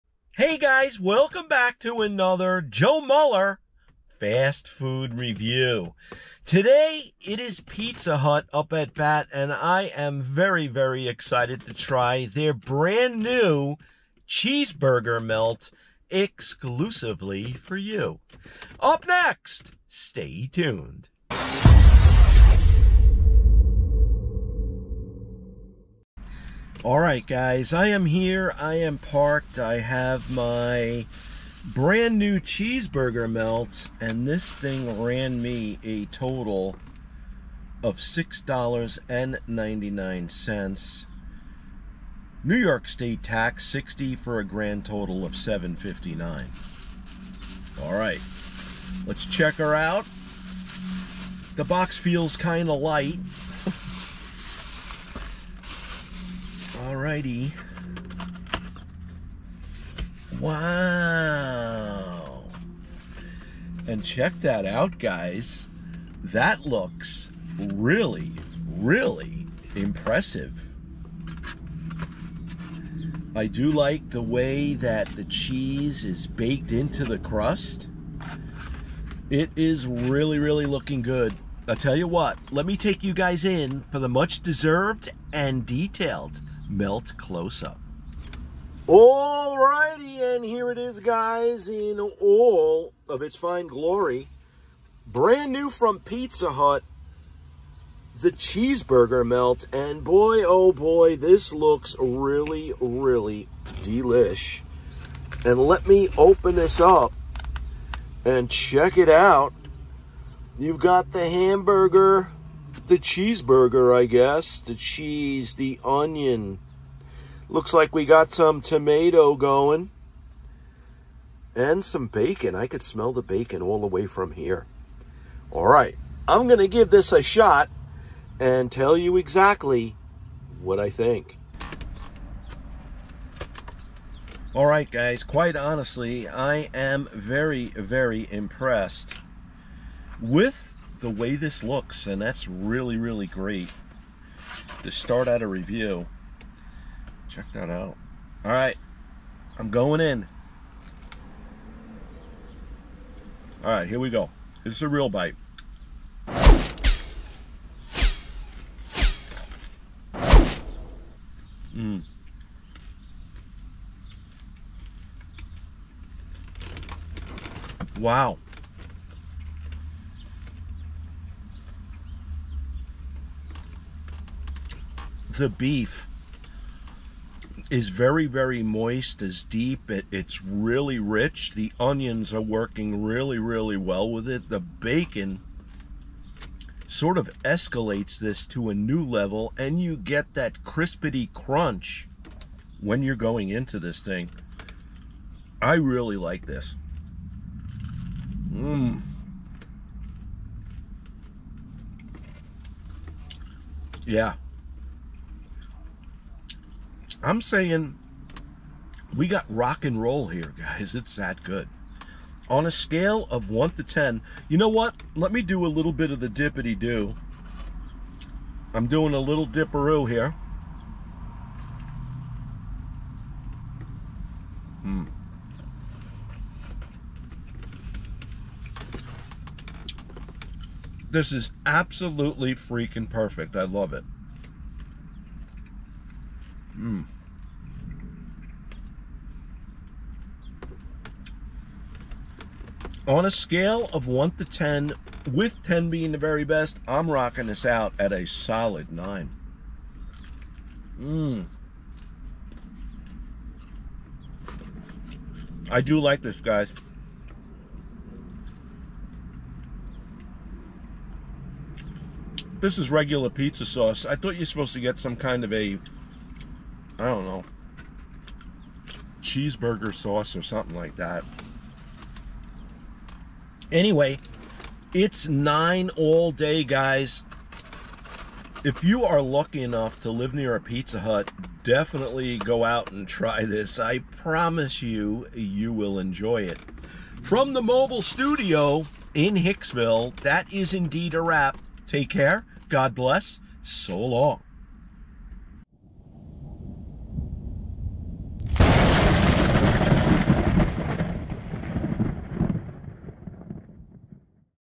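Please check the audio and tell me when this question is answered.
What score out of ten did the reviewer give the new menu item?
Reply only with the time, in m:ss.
4:08.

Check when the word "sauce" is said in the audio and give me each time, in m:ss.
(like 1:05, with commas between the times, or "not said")
4:23, 4:29.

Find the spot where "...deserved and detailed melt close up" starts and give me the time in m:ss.
1:24.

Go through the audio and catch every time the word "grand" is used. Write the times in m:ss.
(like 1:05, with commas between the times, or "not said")
0:44.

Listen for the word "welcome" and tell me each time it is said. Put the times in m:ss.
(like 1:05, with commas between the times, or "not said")
0:00.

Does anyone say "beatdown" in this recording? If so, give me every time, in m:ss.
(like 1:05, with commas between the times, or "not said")
not said.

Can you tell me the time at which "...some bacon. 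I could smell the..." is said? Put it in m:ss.
2:01.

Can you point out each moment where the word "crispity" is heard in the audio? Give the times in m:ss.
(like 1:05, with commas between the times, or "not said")
3:10.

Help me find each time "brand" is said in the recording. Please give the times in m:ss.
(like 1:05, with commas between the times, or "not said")
0:12, 0:31, 1:35.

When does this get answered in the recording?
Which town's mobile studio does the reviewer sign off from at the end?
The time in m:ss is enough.
4:49.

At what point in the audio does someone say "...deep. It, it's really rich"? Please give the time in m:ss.
2:59.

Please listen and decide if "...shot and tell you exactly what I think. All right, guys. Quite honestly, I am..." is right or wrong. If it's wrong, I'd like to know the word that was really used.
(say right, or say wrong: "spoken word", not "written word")
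right.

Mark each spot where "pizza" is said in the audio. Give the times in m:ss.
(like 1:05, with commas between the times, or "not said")
0:07, 1:35, 4:23, 4:40.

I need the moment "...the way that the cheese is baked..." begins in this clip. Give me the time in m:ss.
1:14.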